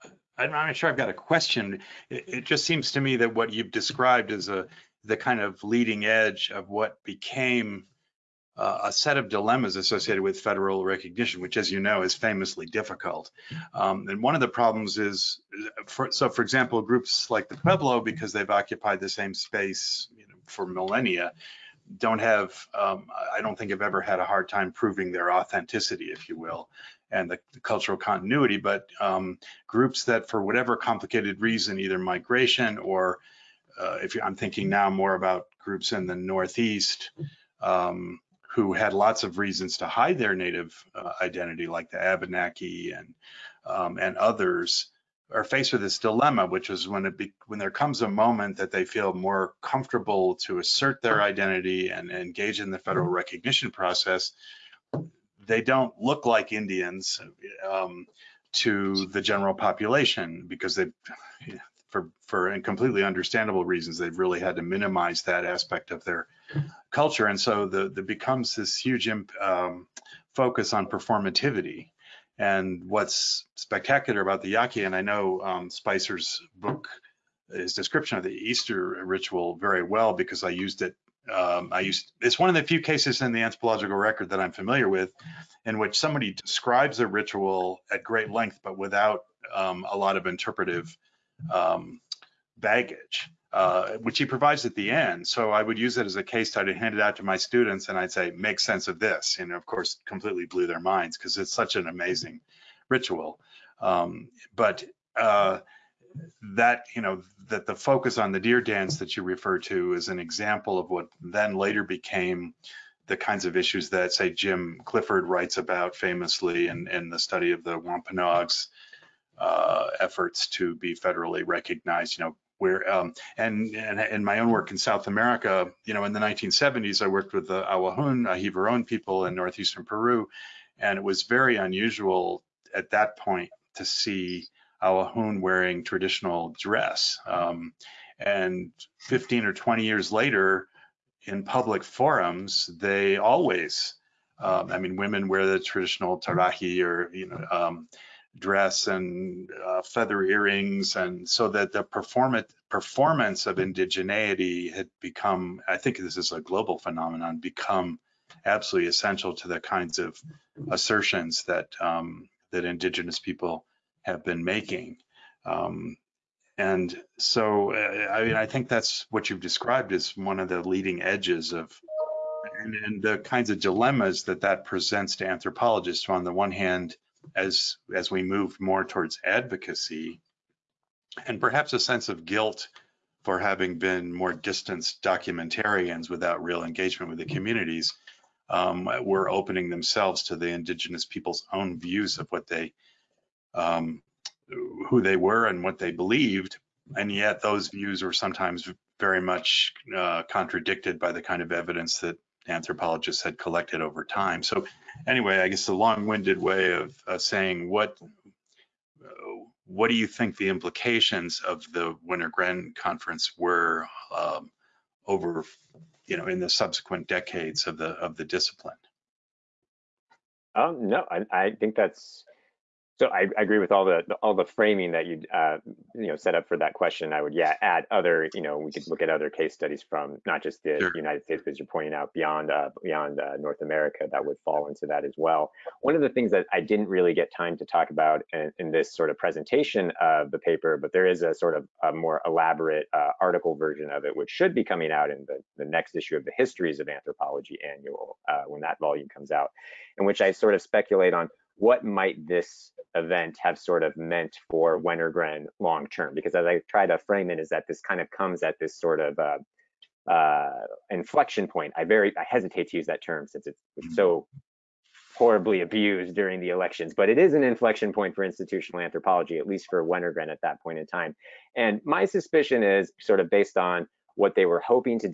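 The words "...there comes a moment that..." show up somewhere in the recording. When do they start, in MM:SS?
00:47.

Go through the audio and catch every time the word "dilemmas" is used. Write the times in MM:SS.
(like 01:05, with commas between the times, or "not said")
00:09, 00:45, 02:53.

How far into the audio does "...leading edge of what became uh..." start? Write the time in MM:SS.
00:05.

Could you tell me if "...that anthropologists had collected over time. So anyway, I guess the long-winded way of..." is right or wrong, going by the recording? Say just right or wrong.
right.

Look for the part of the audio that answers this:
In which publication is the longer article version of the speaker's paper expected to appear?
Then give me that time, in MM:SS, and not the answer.
04:06.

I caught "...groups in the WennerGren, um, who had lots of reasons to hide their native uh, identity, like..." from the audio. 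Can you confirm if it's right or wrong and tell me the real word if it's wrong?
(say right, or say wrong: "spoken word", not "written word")
wrong: "Northeast", not "WennerGren".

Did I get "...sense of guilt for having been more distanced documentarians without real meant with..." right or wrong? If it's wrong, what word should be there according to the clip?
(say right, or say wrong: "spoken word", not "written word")
wrong: "engagement", not "meant".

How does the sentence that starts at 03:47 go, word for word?
I would yeah add other you know we could look at other case studies from not just the sure.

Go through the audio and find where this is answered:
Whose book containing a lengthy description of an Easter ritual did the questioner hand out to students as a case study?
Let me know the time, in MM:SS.
01:15.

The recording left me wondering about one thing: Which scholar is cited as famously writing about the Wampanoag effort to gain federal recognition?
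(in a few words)
Jim Clifford.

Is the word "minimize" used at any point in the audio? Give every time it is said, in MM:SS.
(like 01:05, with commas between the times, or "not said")
01:04.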